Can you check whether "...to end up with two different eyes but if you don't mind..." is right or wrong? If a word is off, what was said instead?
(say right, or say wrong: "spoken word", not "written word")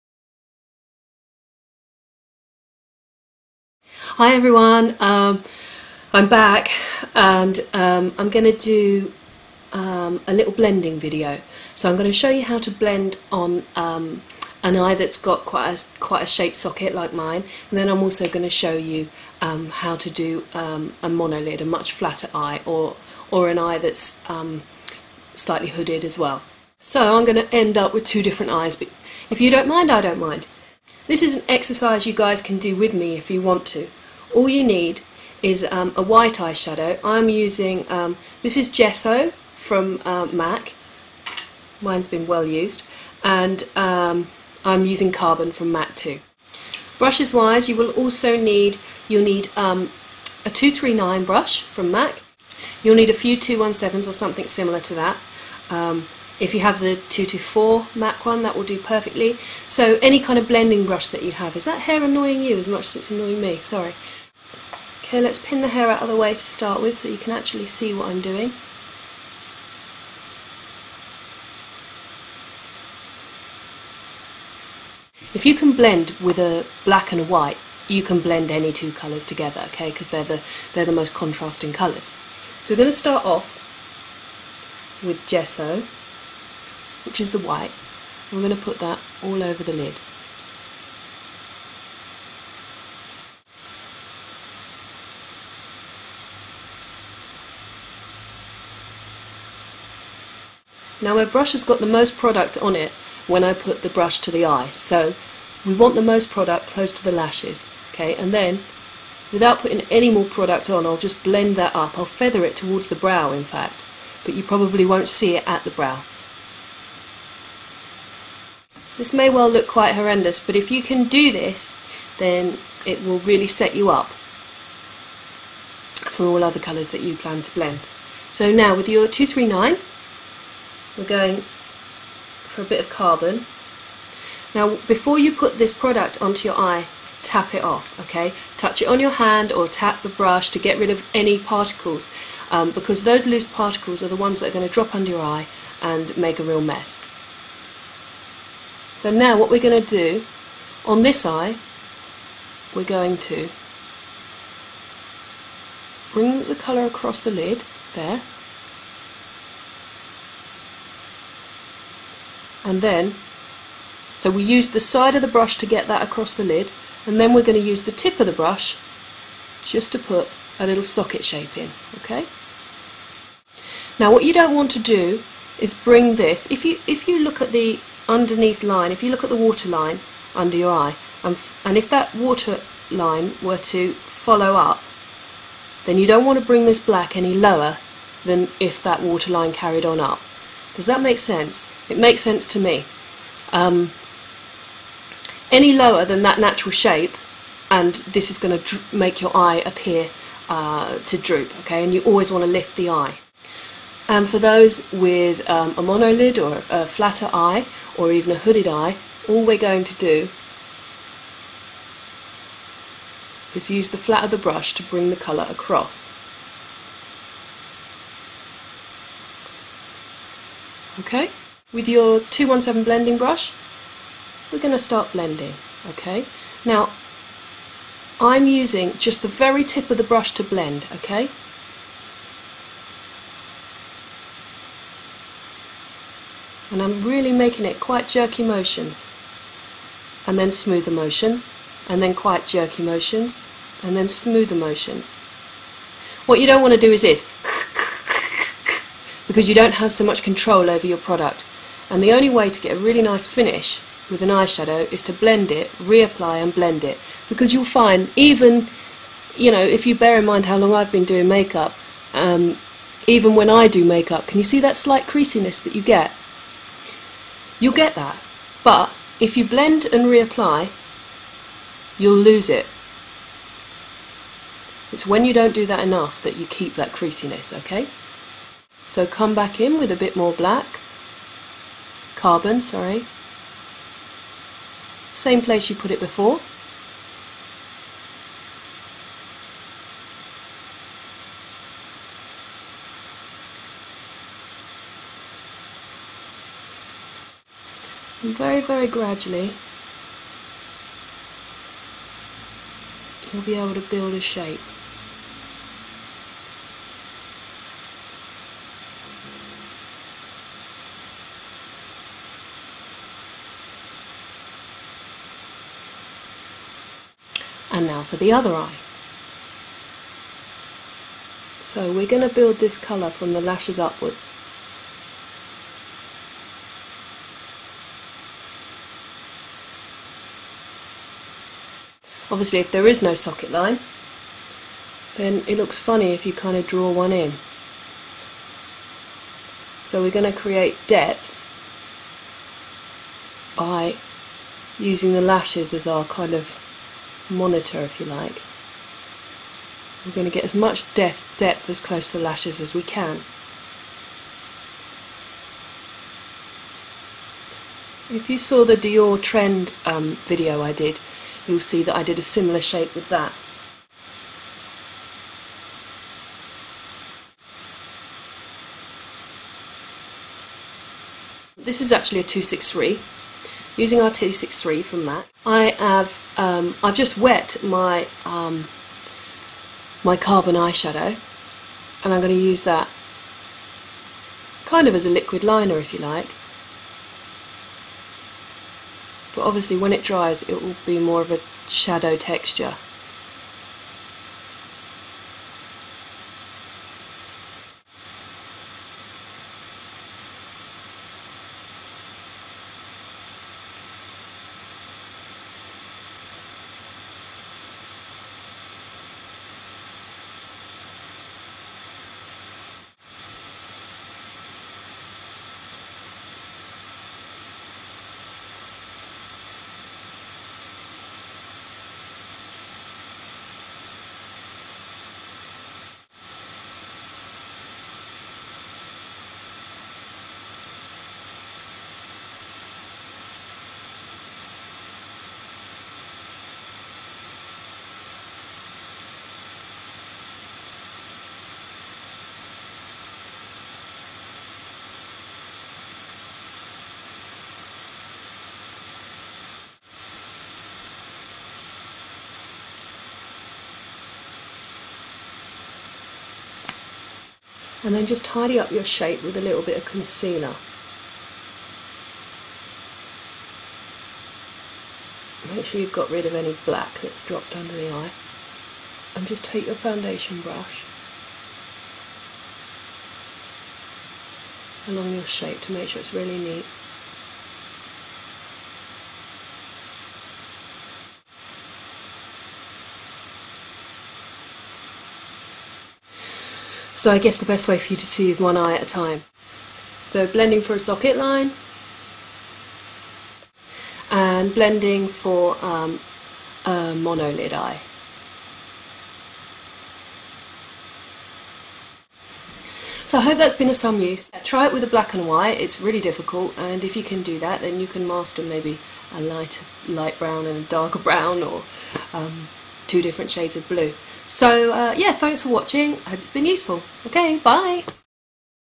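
right.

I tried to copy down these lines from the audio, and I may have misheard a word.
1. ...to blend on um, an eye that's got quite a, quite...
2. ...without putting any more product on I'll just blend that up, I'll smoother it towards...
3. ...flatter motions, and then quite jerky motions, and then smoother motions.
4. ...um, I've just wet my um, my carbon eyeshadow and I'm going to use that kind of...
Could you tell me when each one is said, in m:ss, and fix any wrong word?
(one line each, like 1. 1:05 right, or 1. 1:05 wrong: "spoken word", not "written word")
1. 0:12 right
2. 1:49 wrong: "feather", not "smoother"
3. 4:00 wrong: "smoother", not "flatter"
4. 6:16 right.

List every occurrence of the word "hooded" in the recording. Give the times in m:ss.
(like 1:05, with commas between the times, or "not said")
0:25, 3:28.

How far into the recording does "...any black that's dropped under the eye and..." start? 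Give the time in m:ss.
7:46.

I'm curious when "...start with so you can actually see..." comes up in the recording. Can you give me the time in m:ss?
1:06.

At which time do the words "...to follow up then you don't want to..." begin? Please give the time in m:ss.
3:03.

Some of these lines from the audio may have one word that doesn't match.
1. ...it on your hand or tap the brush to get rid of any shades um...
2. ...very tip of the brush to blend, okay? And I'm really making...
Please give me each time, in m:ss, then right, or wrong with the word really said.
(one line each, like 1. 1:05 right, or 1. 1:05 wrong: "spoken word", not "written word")
1. 2:18 wrong: "particles", not "shades"
2. 3:49 right.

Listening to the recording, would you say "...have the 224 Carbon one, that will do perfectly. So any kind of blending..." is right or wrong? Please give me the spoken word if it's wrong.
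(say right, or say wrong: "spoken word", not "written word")
wrong: "MAC", not "Carbon".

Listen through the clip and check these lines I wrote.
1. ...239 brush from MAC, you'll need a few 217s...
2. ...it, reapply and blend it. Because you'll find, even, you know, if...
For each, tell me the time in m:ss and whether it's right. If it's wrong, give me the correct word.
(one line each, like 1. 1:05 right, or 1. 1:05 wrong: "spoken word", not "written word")
1. 0:50 right
2. 4:15 right.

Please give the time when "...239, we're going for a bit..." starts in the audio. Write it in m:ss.
2:09.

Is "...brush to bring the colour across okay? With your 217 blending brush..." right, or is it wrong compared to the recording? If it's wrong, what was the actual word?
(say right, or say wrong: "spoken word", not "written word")
right.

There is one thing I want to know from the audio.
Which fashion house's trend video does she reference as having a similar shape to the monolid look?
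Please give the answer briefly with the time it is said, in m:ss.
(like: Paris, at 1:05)
Dior, at 5:58.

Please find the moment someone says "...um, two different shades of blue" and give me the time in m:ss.
8:32.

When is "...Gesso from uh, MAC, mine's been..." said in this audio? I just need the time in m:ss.
0:38.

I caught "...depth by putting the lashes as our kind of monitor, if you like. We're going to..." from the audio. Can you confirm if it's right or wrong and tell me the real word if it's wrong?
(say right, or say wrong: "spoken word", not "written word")
wrong: "using", not "putting".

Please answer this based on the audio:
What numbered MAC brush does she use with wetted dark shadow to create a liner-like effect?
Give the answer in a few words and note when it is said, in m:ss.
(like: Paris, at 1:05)
263, at 6:12.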